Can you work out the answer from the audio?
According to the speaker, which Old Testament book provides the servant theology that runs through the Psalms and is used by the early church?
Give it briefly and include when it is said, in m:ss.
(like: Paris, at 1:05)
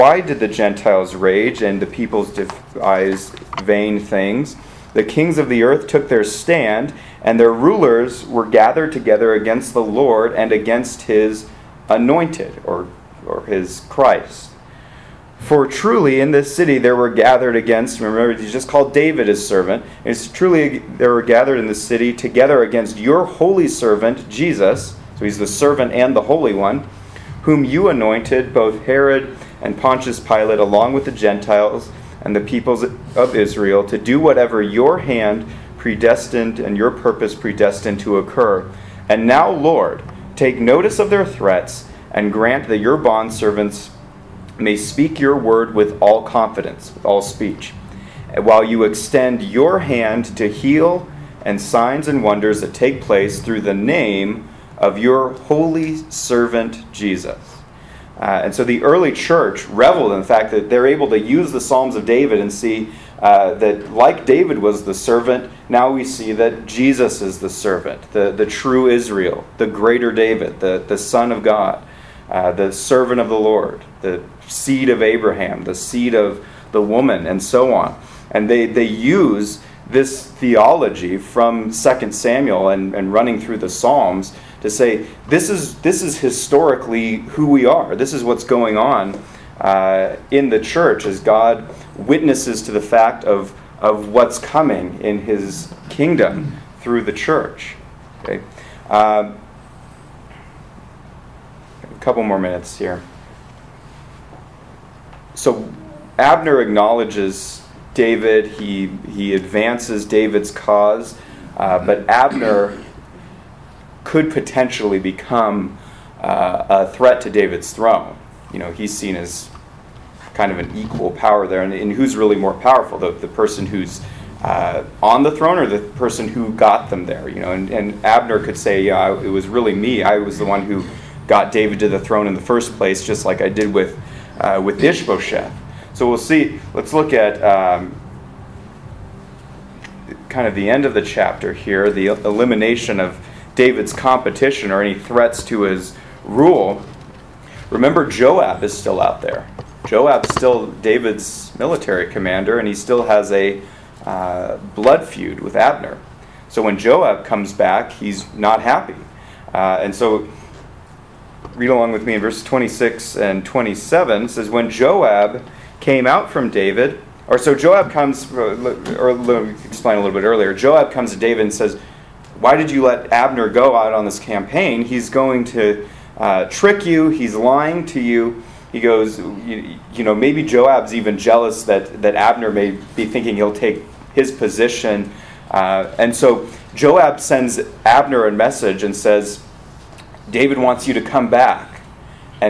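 2 Samuel, at 1:21.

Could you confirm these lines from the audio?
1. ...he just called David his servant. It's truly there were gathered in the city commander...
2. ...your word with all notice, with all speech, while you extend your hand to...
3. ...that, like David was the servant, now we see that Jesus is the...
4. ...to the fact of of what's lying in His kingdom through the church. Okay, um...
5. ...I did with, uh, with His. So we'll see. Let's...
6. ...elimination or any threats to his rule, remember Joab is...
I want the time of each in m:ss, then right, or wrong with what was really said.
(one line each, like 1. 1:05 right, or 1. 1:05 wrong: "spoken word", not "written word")
1. 0:18 wrong: "together", not "commander"
2. 0:45 wrong: "confidence", not "notice"
3. 1:03 right
4. 1:32 wrong: "coming", not "lying"
5. 2:13 wrong: "Ishbosheth", not "His"
6. 2:23 wrong: "competition", not "elimination".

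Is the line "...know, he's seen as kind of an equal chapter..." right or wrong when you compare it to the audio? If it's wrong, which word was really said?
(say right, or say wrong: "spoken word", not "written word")
wrong: "power", not "chapter".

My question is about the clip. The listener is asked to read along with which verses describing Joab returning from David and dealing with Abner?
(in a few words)
Verses 26 and 27.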